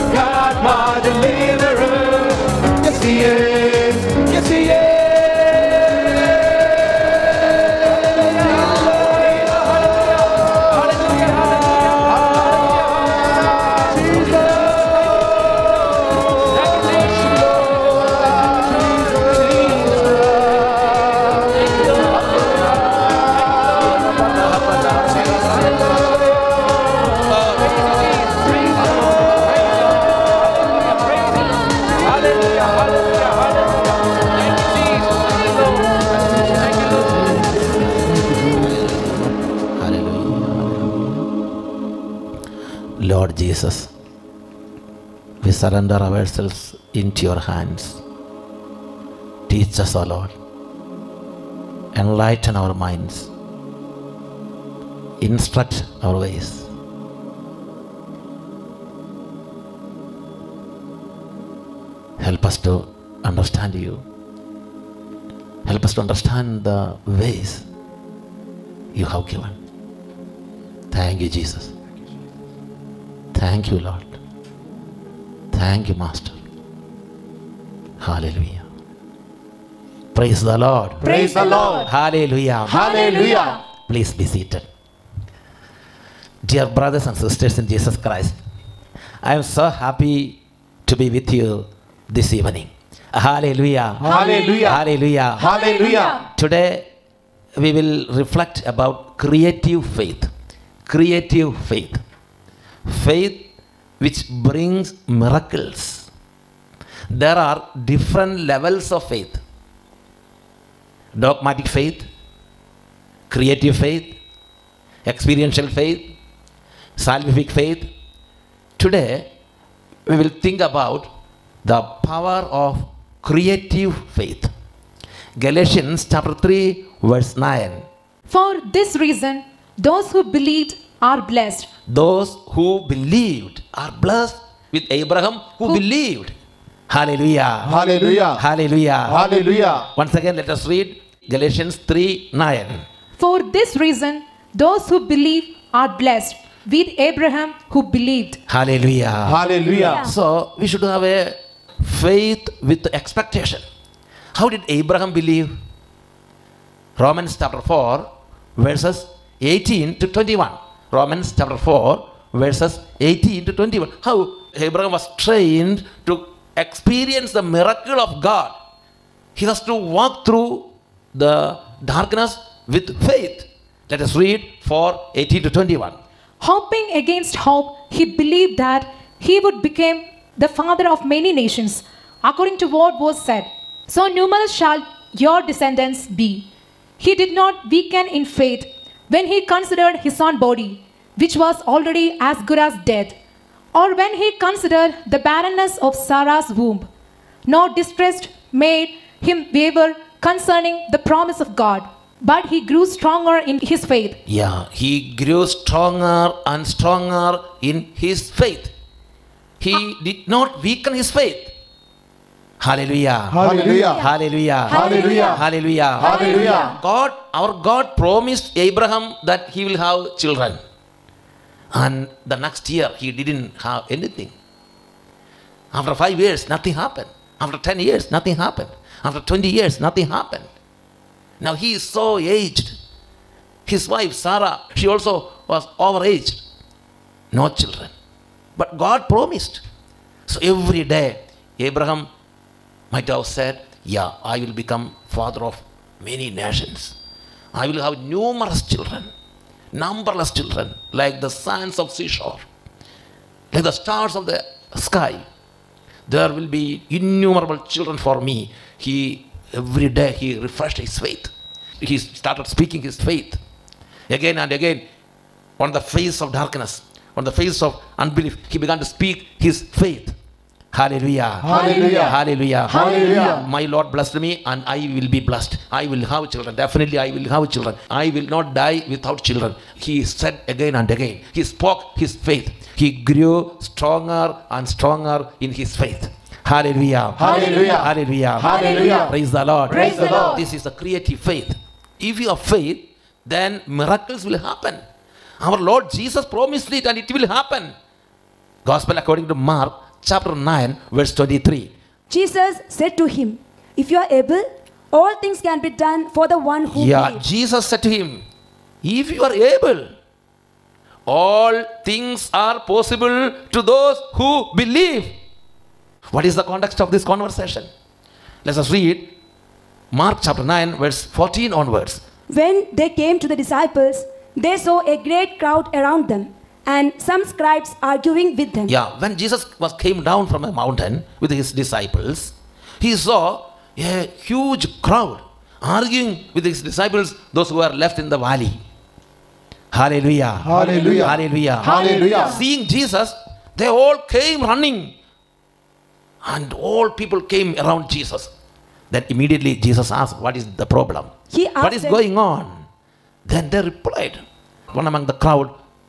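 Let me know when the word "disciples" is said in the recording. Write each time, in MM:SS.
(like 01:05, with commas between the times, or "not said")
05:23, 05:31, 05:36.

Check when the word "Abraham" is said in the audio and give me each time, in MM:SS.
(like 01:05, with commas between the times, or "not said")
02:14, 02:27, 02:34, 02:44, 03:38, 04:01.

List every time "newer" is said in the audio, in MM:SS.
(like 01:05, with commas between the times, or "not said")
not said.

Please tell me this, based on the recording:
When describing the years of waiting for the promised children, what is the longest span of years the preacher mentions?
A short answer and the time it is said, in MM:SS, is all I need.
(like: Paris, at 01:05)
20 years, at 03:49.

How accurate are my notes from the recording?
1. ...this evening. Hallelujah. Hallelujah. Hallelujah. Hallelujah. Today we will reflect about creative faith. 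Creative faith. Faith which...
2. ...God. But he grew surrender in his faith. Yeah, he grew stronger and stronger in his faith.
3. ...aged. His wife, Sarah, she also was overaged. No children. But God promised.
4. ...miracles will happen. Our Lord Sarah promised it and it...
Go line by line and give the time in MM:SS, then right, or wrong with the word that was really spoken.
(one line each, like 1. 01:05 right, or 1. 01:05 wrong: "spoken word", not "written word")
1. 01:32 right
2. 03:21 wrong: "stronger", not "surrender"
3. 03:52 right
4. 04:53 wrong: "Jesus", not "Sarah".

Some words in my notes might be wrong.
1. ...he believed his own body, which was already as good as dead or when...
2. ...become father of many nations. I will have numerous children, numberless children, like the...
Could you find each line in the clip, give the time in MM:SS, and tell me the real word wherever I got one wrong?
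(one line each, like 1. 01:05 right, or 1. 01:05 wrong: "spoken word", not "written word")
1. 03:09 wrong: "considered", not "believed"
2. 04:04 right.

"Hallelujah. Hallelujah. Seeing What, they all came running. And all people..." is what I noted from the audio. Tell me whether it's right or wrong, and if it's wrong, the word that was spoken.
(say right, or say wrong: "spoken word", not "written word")
wrong: "Jesus", not "What".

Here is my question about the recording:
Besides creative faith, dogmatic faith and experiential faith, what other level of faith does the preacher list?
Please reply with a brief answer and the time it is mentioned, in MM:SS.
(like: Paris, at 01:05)
Salvific faith, at 01:56.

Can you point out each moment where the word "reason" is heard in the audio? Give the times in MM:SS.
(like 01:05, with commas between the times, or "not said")
02:08, 02:23.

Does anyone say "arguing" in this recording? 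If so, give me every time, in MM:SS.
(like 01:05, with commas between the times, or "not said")
05:27, 05:35.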